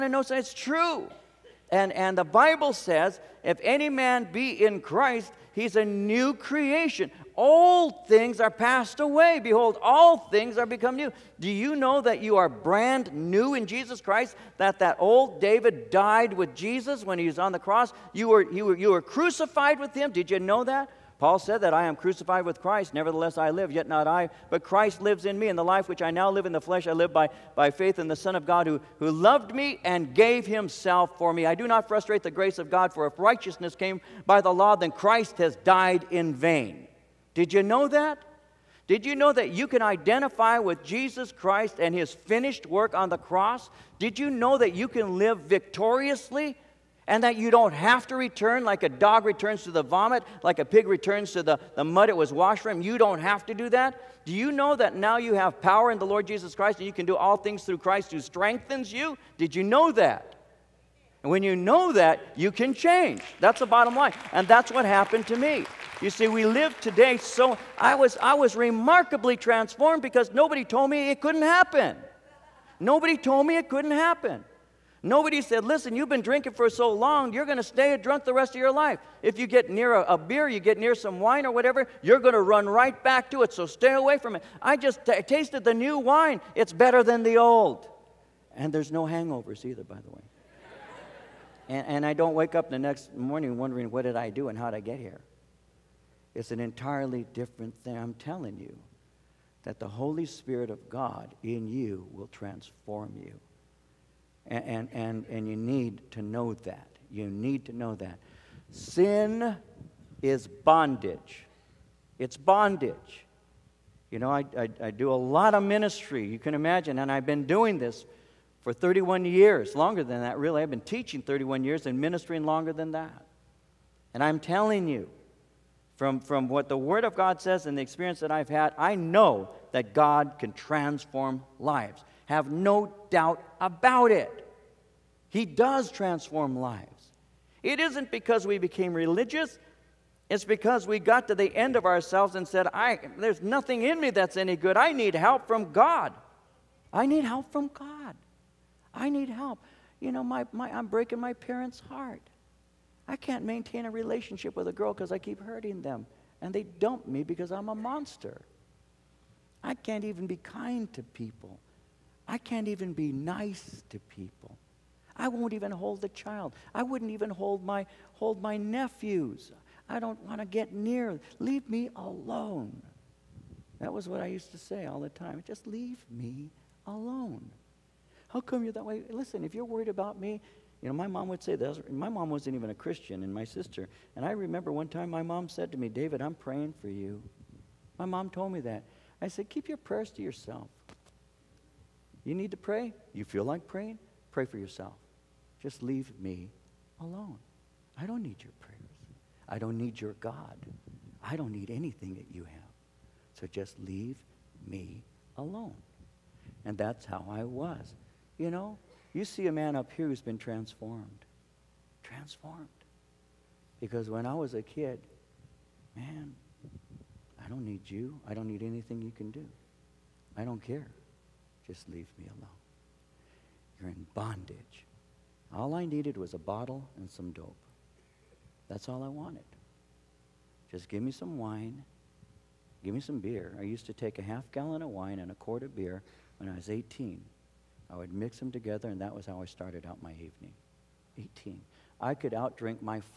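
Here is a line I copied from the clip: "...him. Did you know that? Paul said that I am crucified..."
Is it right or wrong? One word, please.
right.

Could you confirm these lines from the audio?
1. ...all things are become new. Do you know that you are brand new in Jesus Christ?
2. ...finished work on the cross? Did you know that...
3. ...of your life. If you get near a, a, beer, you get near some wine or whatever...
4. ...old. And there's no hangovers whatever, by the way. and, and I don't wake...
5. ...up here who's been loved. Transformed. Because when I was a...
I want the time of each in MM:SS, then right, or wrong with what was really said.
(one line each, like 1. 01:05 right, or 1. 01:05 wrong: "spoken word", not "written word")
1. 00:09 right
2. 00:42 right
3. 01:18 right
4. 01:27 wrong: "either", not "whatever"
5. 03:29 wrong: "transformed", not "loved".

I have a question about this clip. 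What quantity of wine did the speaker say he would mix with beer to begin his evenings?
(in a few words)
half gallon.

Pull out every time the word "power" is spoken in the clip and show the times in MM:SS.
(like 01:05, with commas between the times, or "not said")
00:55.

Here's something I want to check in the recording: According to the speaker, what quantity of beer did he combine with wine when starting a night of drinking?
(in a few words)
a quart.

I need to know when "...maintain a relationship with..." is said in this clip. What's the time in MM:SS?
02:33.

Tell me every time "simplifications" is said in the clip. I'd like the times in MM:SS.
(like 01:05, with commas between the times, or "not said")
not said.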